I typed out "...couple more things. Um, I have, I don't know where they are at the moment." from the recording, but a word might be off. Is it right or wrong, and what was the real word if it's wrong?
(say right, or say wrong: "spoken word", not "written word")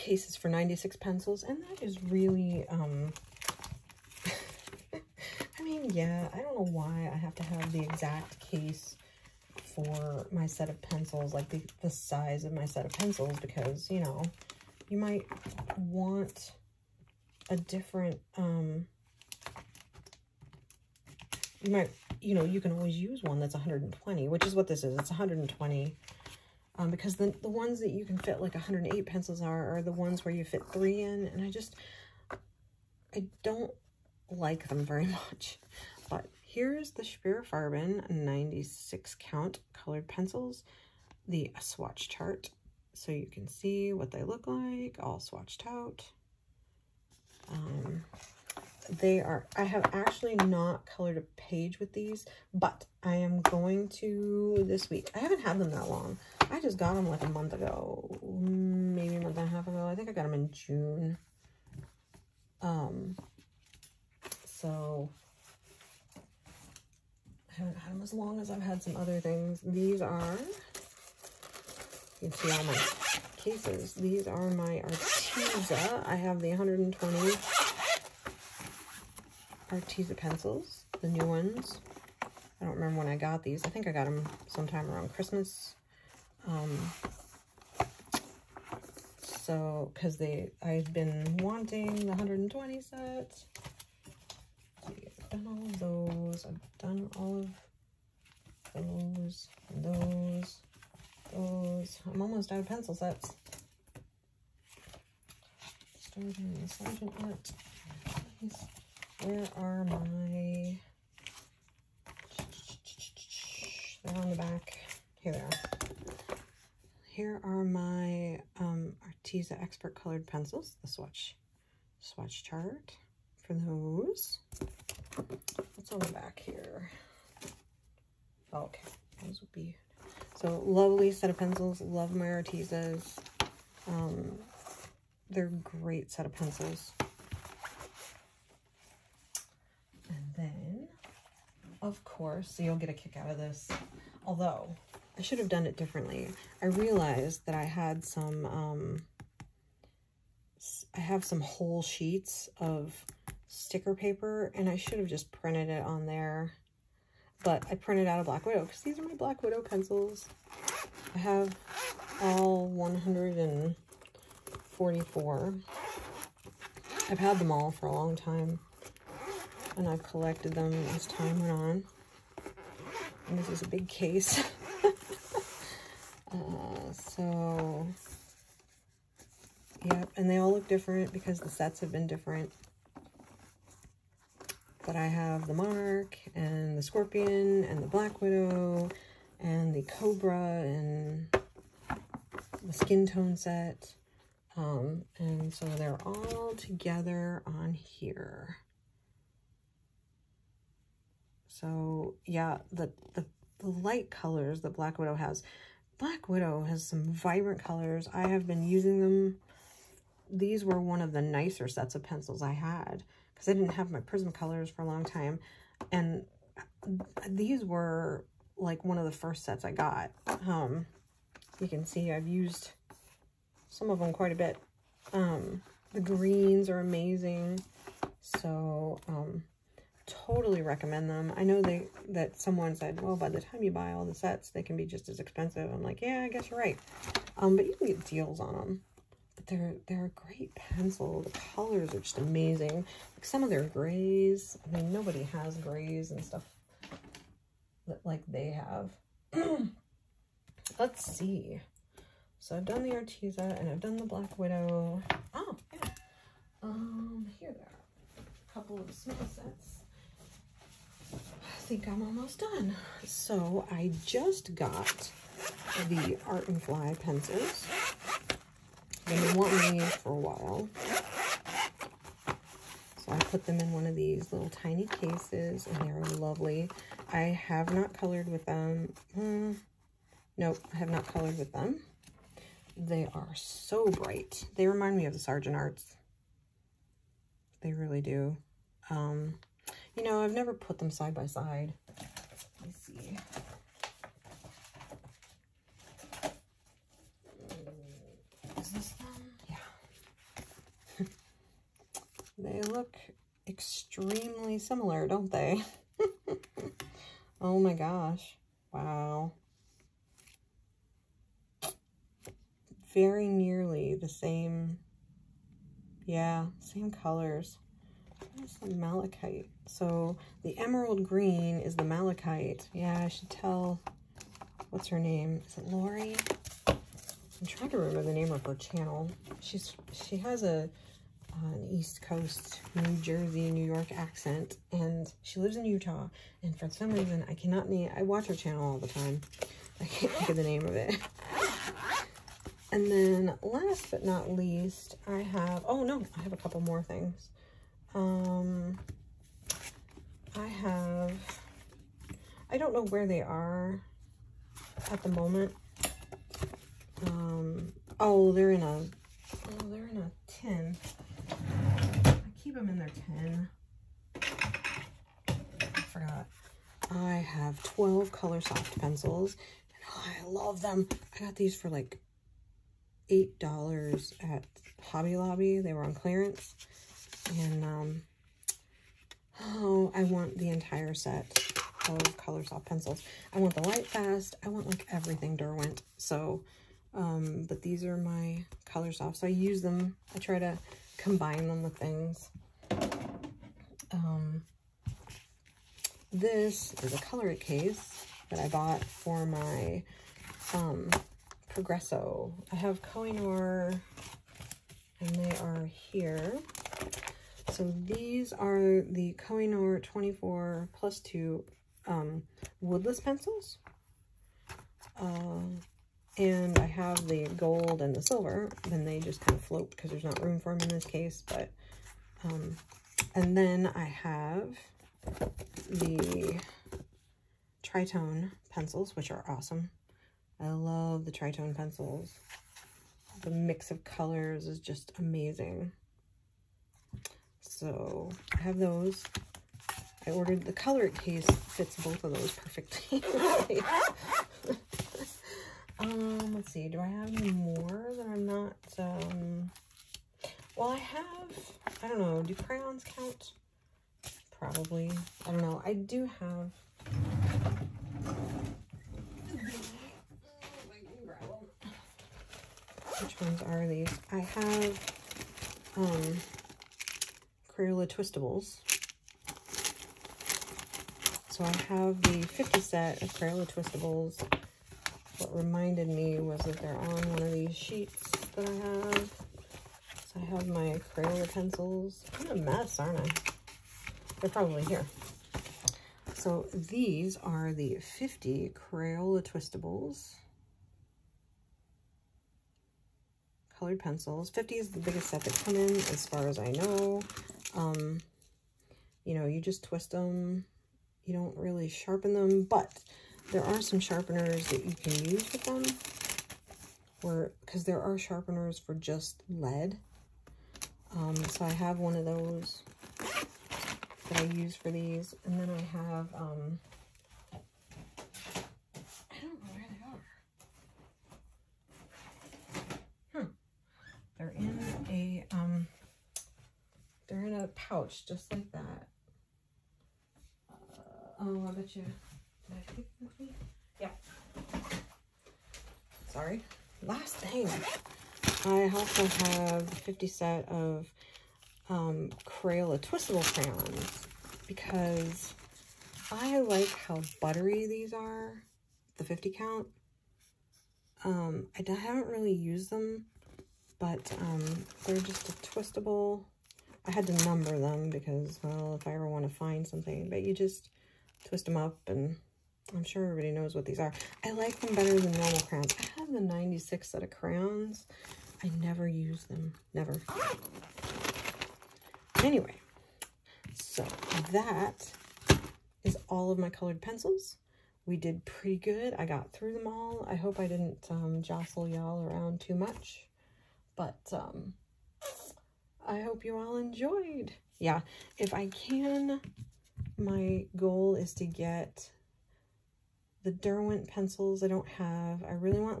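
right.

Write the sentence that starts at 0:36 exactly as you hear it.
But here's the Speer 96 count colored pencils, the swatch chart.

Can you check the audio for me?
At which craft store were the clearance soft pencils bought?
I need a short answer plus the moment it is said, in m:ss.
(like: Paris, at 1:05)
Hobby Lobby, at 6:14.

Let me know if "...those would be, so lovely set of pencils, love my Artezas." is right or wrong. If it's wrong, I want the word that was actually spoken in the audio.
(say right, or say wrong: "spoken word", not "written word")
right.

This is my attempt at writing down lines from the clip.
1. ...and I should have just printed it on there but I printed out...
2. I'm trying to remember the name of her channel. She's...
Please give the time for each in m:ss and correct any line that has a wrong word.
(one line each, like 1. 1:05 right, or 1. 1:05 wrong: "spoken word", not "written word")
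1. 2:34 right
2. 5:26 right.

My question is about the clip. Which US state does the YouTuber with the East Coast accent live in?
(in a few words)
Utah.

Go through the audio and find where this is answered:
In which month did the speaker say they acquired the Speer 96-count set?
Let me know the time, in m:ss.
1:00.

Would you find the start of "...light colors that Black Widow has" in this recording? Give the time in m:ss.
3:23.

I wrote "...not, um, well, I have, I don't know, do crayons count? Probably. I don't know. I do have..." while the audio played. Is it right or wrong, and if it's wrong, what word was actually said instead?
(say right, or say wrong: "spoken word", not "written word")
right.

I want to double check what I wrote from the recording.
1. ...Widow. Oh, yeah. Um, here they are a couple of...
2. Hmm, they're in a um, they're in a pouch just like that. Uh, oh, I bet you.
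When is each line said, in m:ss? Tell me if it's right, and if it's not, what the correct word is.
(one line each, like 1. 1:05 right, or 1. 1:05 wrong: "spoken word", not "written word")
1. 4:14 right
2. 8:43 right.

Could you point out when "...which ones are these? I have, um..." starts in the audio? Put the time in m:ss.
7:43.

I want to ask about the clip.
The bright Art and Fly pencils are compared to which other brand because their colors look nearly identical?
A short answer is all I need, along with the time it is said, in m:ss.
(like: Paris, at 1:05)
Sargent Art, at 4:45.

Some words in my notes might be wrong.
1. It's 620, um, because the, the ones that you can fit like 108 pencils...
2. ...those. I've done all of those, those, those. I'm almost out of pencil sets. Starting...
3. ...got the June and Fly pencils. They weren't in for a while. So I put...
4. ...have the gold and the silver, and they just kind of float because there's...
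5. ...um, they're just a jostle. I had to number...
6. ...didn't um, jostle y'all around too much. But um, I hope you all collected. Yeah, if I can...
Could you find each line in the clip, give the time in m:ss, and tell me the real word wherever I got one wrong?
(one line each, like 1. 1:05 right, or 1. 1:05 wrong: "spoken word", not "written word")
1. 0:24 wrong: "120", not "620"
2. 1:35 right
3. 4:24 wrong: "Art", not "June"
4. 6:56 right
5. 9:14 wrong: "twistable", not "jostle"
6. 9:40 wrong: "enjoyed", not "collected".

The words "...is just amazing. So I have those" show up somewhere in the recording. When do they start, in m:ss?
7:14.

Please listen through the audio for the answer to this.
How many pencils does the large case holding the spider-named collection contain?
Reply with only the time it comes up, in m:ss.
2:42.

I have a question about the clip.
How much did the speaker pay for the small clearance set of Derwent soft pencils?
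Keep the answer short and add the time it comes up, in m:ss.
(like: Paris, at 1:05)
$8, at 6:13.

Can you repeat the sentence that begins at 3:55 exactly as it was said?
I'm like, yeah, I guess you're right.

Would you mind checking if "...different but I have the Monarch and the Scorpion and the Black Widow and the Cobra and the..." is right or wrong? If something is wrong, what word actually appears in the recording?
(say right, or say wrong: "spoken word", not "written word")
right.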